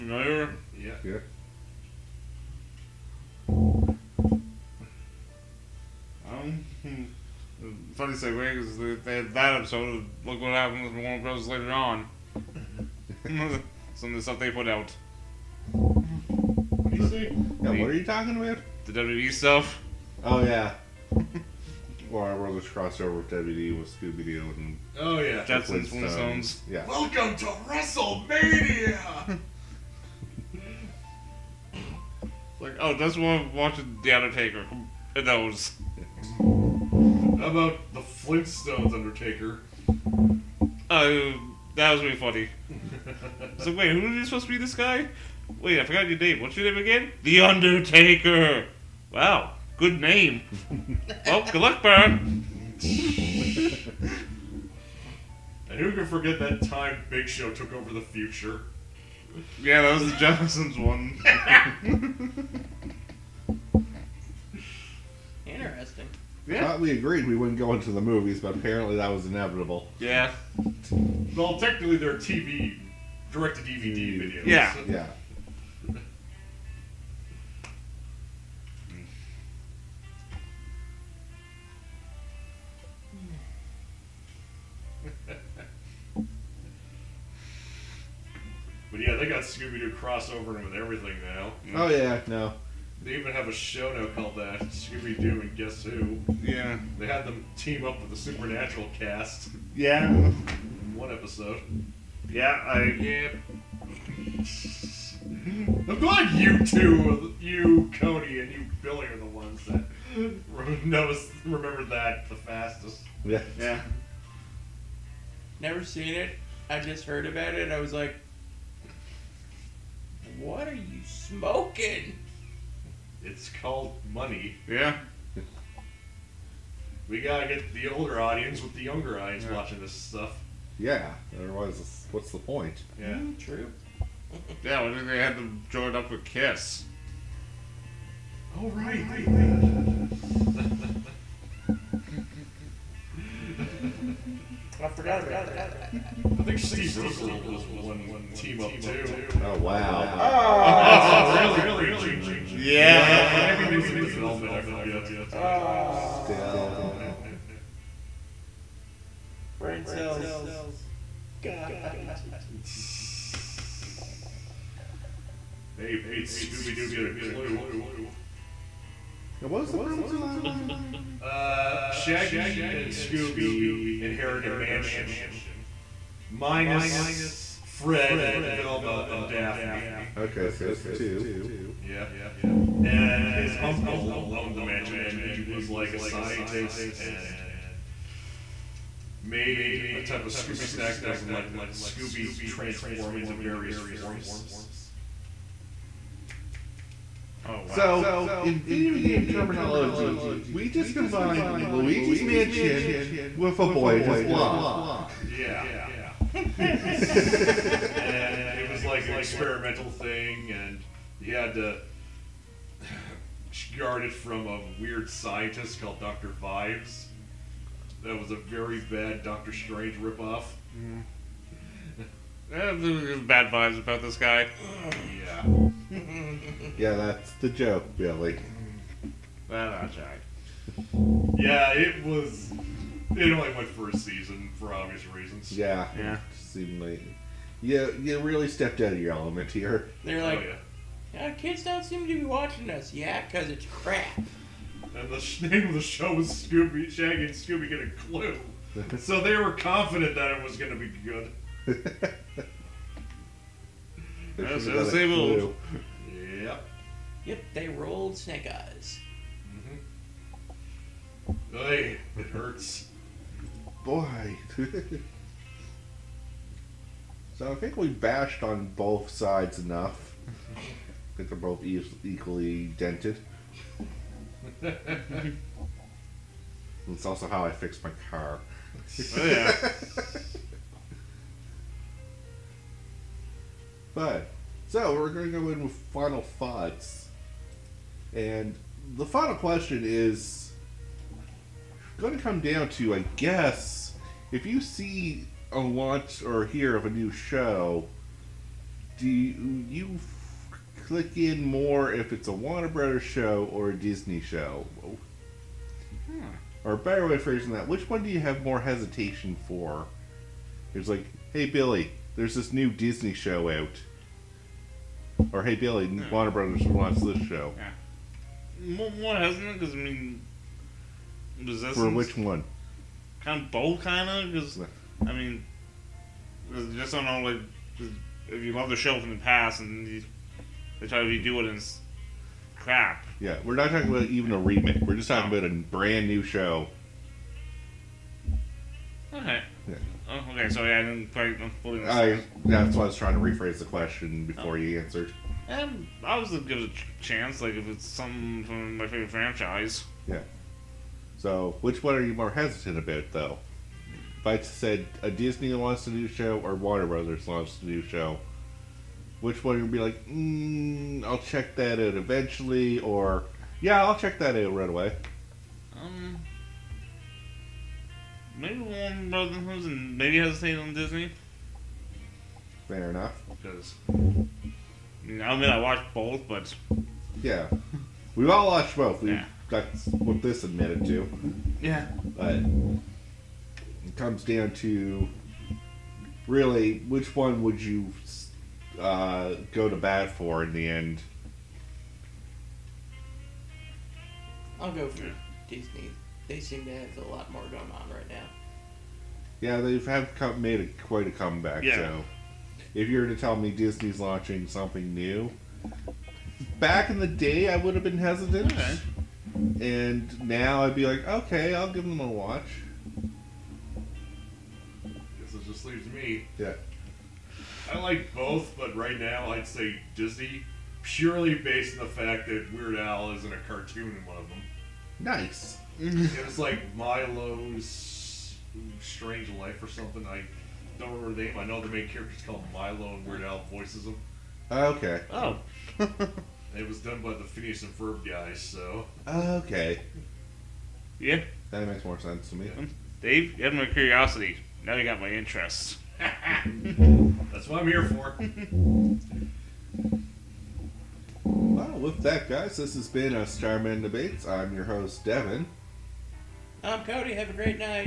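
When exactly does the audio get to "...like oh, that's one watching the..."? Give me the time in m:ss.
0:32.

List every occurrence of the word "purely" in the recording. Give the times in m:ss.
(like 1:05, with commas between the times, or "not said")
7:00.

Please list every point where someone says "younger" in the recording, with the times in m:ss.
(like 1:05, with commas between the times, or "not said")
2:08.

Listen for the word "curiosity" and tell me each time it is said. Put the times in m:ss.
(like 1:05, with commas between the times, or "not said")
7:23.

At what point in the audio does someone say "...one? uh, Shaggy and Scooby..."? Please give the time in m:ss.
2:50.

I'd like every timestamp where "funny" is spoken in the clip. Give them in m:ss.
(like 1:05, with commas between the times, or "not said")
0:07, 0:42.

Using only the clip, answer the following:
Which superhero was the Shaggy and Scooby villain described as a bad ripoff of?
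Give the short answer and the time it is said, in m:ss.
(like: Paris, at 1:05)
Doctor Strange, at 3:39.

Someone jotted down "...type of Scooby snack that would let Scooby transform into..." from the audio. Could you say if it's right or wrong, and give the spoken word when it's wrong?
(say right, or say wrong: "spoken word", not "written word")
right.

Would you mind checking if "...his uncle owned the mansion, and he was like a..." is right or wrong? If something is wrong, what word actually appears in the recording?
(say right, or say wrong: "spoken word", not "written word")
right.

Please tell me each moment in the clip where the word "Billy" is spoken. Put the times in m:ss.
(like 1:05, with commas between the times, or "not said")
1:48, 3:47, 5:11, 5:15.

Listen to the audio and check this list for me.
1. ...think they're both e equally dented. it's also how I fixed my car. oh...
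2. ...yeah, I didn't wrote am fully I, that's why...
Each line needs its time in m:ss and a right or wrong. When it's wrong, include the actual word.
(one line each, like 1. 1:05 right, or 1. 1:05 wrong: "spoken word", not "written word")
1. 4:31 right
2. 5:40 wrong: "quite", not "wrote".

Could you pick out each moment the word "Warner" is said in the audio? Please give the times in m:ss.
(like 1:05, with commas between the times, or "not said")
0:11, 5:02, 5:16, 5:56, 6:08.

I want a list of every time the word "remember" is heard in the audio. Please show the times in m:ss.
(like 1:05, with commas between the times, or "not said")
1:51, 7:10.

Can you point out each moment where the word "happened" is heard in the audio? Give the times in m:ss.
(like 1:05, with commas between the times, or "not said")
0:10.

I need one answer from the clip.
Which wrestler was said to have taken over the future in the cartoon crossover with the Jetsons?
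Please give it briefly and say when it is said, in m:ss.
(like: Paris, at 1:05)
Big Show, at 0:57.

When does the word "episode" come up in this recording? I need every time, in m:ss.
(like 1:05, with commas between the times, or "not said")
0:09, 1:41.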